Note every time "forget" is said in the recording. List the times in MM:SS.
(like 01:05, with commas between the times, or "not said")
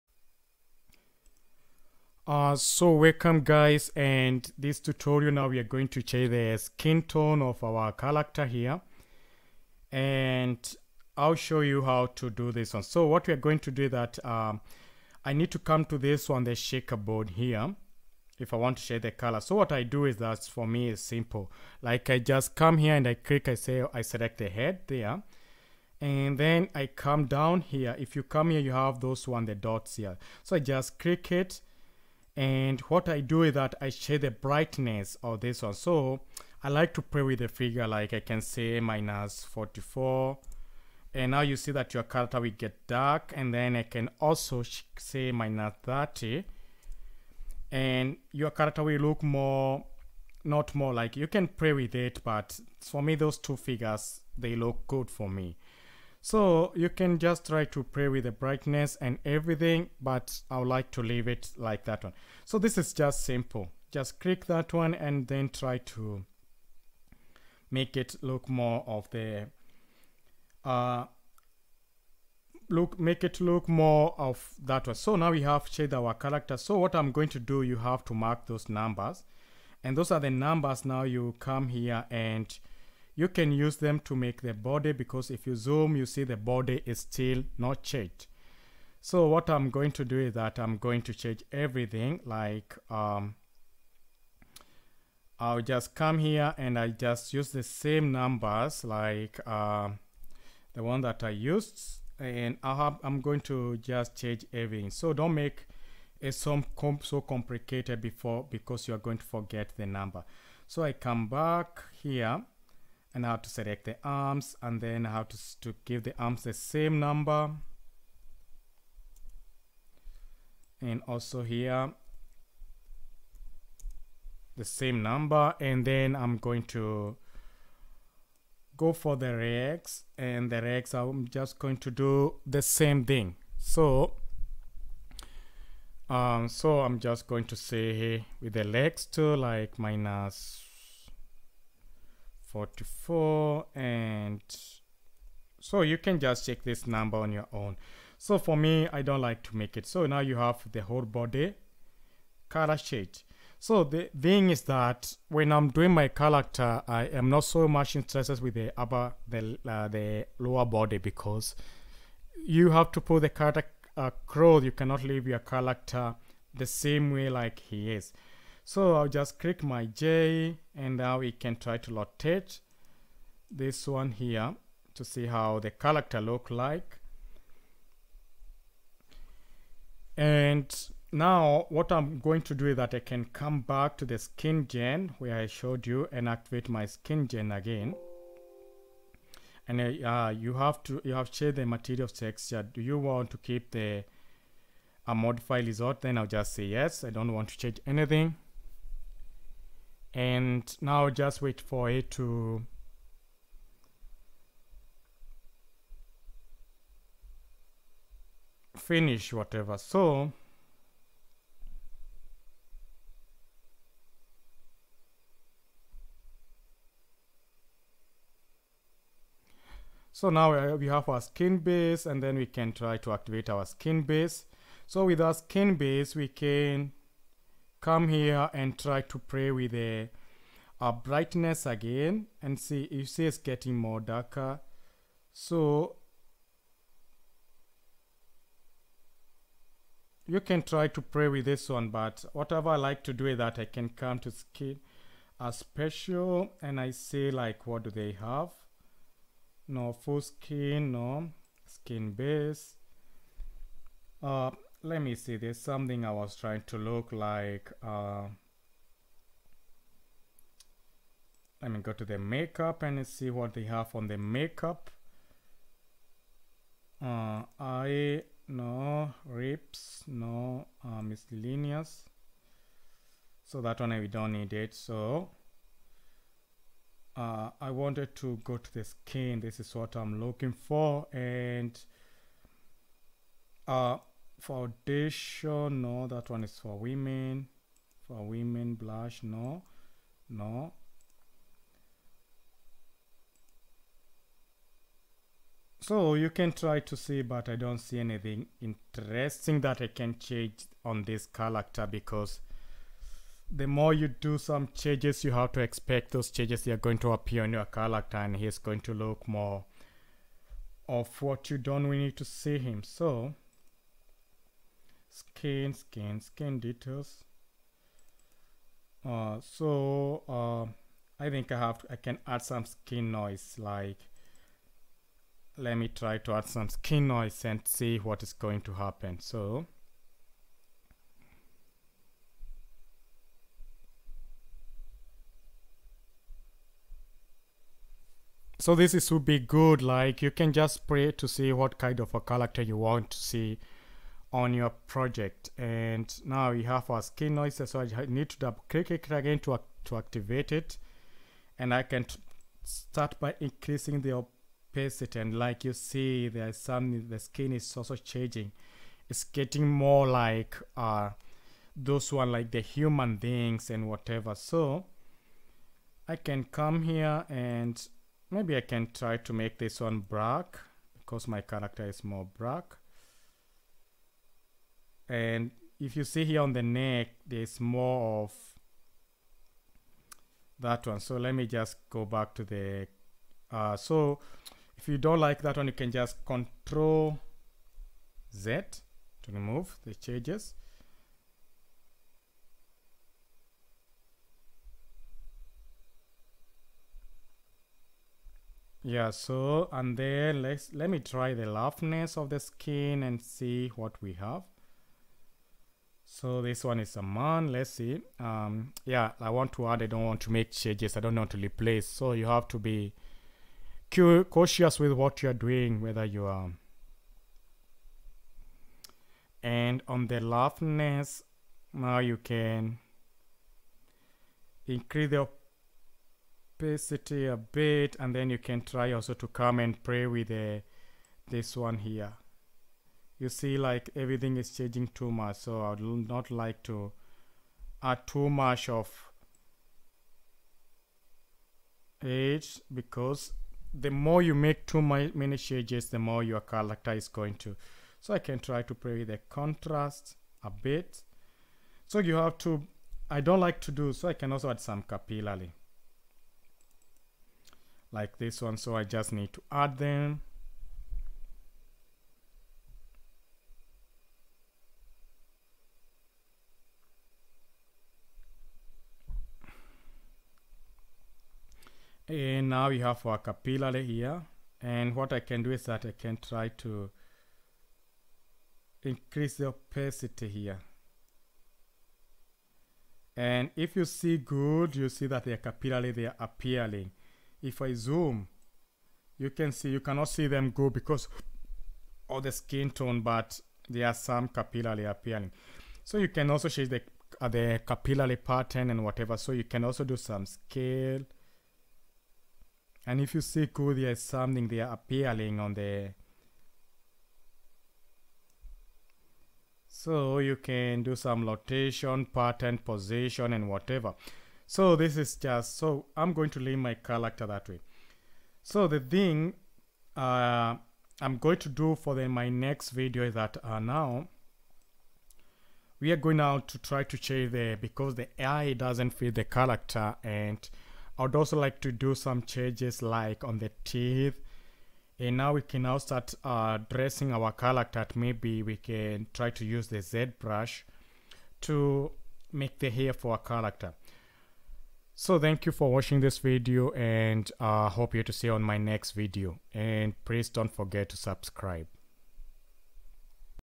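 01:49, 09:10.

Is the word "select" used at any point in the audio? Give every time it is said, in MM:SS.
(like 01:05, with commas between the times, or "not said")
00:24, 01:53.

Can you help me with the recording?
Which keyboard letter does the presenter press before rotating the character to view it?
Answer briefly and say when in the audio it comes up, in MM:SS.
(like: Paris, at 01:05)
J, at 02:49.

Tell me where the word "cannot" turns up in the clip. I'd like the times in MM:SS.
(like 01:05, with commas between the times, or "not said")
02:44, 08:09.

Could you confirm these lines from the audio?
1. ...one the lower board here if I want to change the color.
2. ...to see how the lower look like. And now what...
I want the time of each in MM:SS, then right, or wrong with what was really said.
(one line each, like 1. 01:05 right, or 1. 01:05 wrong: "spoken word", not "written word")
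1. 00:16 wrong: "shaker", not "lower"
2. 02:54 wrong: "character", not "lower".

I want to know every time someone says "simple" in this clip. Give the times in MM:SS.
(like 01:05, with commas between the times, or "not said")
00:21, 01:03.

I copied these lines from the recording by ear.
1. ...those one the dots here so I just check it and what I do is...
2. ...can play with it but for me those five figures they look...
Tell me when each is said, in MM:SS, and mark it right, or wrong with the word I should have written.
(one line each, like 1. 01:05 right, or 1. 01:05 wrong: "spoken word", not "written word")
1. 00:28 wrong: "click", not "check"
2. 00:51 wrong: "two", not "five".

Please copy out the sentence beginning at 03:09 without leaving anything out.
And uh, you have to you have changed the material texture.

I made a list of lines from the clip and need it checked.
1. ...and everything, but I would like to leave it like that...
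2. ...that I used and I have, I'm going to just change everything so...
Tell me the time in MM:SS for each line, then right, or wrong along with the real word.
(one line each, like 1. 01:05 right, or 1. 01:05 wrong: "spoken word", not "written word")
1. 00:59 right
2. 01:41 right.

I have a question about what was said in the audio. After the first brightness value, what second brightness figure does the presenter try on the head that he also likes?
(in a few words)
-30.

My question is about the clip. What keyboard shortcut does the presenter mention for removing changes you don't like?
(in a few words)
Control Z.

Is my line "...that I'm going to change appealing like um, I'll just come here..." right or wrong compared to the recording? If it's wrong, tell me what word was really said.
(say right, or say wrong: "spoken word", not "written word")
wrong: "everything", not "appealing".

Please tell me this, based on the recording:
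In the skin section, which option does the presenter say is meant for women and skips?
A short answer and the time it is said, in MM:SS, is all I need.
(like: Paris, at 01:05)
Foundation, at 04:44.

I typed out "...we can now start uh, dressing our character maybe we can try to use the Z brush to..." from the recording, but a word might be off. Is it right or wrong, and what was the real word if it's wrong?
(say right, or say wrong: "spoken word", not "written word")
right.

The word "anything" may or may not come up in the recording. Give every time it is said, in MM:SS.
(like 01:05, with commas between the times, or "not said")
03:17, 04:57.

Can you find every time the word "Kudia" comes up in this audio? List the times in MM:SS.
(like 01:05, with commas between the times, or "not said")
08:23.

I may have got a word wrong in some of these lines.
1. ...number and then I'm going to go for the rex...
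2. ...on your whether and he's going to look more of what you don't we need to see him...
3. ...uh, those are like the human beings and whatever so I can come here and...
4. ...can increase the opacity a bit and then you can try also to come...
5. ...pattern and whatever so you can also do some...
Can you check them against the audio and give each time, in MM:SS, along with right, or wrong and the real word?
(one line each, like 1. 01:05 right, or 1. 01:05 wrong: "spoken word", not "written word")
1. 02:05 right
2. 05:07 wrong: "character", not "whether"
3. 06:00 right
4. 07:02 right
5. 08:18 right.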